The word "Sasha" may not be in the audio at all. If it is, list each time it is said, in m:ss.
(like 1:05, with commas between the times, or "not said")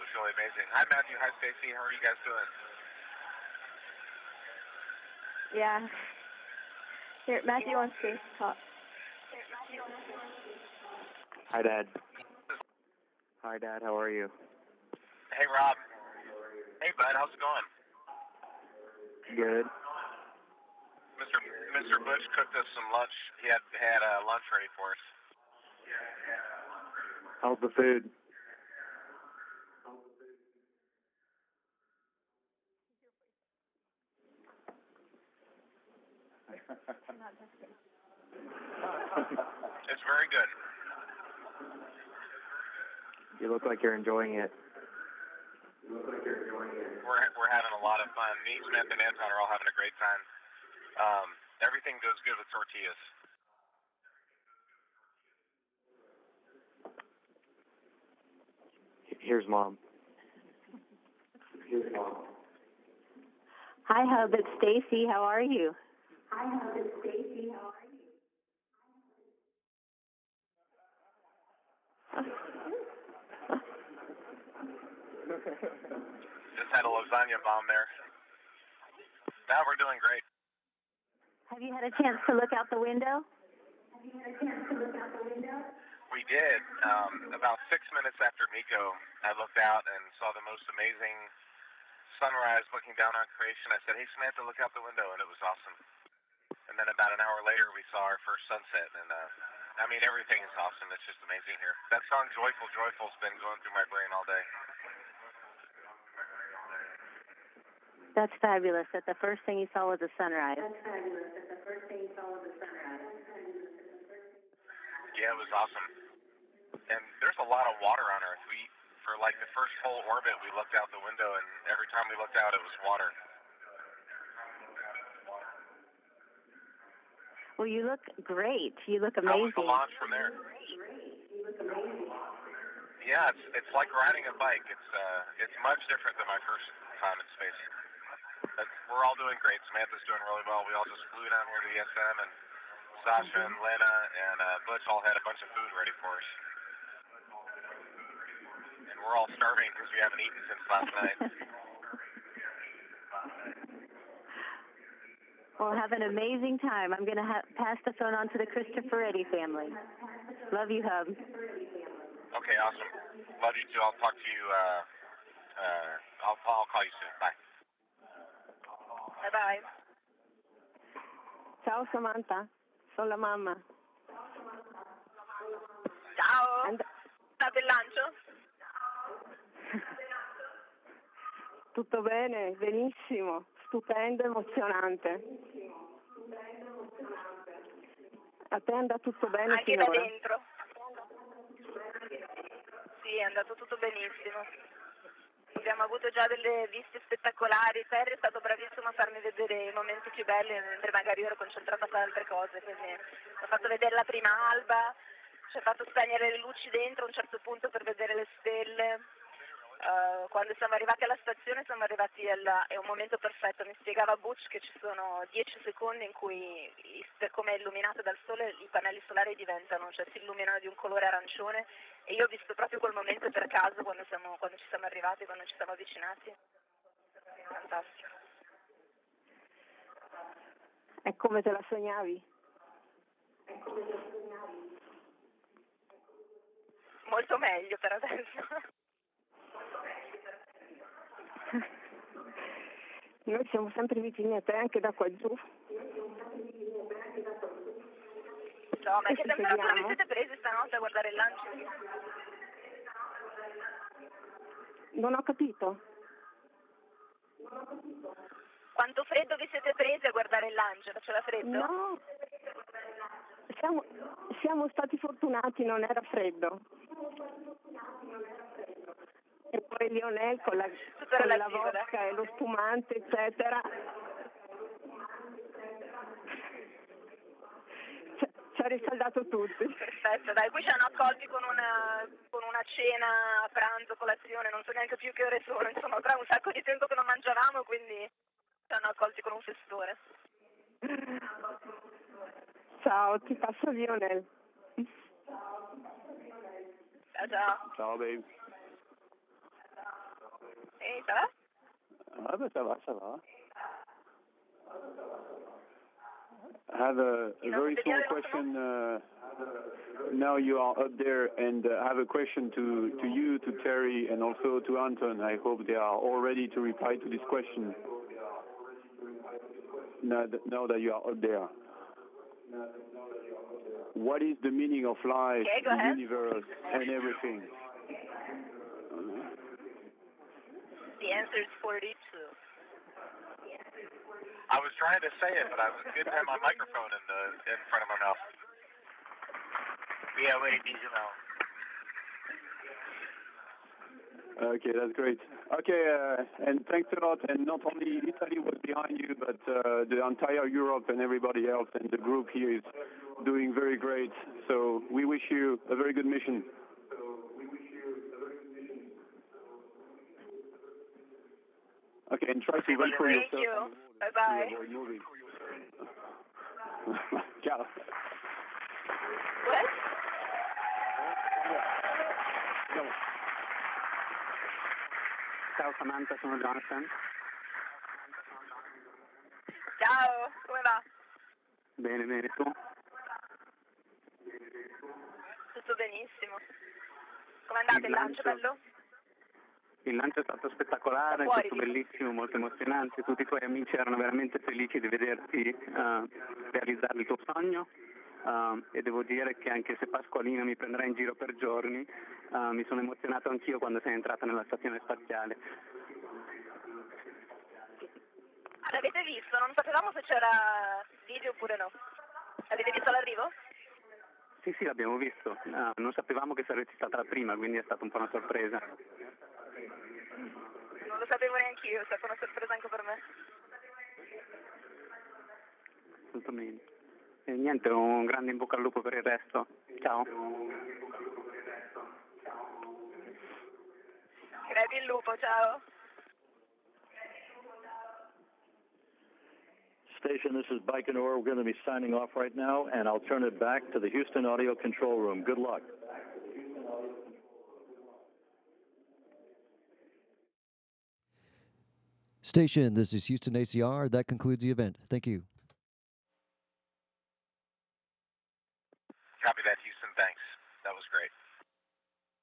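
2:23.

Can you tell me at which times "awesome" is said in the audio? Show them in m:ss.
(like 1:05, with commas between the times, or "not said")
1:35, 1:40, 1:55, 2:42.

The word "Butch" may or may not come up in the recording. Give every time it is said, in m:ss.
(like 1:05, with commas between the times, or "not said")
2:24, 3:34.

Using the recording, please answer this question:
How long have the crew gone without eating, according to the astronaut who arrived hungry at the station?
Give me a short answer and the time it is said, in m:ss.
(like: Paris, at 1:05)
Since last night, at 2:30.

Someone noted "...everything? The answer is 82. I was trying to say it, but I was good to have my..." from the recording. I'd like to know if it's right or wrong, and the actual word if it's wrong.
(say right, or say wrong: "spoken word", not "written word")
wrong: "42", not "82".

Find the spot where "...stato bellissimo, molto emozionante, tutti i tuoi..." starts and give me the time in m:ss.
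6:31.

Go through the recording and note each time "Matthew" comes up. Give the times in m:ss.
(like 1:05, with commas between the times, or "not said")
0:00, 0:07.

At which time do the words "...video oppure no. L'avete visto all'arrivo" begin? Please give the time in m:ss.
6:51.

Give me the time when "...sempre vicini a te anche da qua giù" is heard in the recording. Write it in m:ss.
4:03.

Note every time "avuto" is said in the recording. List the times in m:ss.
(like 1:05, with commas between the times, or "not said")
3:15.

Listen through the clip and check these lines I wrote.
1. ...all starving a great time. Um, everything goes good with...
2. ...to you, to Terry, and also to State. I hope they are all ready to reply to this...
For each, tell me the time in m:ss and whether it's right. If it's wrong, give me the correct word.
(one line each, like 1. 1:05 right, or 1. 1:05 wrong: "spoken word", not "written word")
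1. 0:49 wrong: "having", not "starving"
2. 5:13 wrong: "Anton", not "State".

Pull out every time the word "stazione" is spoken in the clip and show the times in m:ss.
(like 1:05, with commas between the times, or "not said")
3:31, 6:44.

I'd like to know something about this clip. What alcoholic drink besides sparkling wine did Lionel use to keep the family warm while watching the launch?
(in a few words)
Vodka.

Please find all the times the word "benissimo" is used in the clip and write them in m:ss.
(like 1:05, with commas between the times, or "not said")
3:02, 3:13, 6:25.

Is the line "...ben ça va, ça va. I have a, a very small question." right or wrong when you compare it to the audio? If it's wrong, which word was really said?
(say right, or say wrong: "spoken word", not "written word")
right.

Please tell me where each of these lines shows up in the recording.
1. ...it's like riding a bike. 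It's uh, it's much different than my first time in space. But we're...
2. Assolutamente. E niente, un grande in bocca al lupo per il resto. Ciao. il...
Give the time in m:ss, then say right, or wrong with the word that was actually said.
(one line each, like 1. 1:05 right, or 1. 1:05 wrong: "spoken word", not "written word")
1. 2:13 right
2. 7:06 right.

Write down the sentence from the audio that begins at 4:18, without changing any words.
Quanto freddo vi siete prese a guardare il lancio?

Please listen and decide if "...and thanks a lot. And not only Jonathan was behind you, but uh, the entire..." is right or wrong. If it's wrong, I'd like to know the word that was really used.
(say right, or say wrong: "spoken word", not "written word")
wrong: "Italy", not "Jonathan".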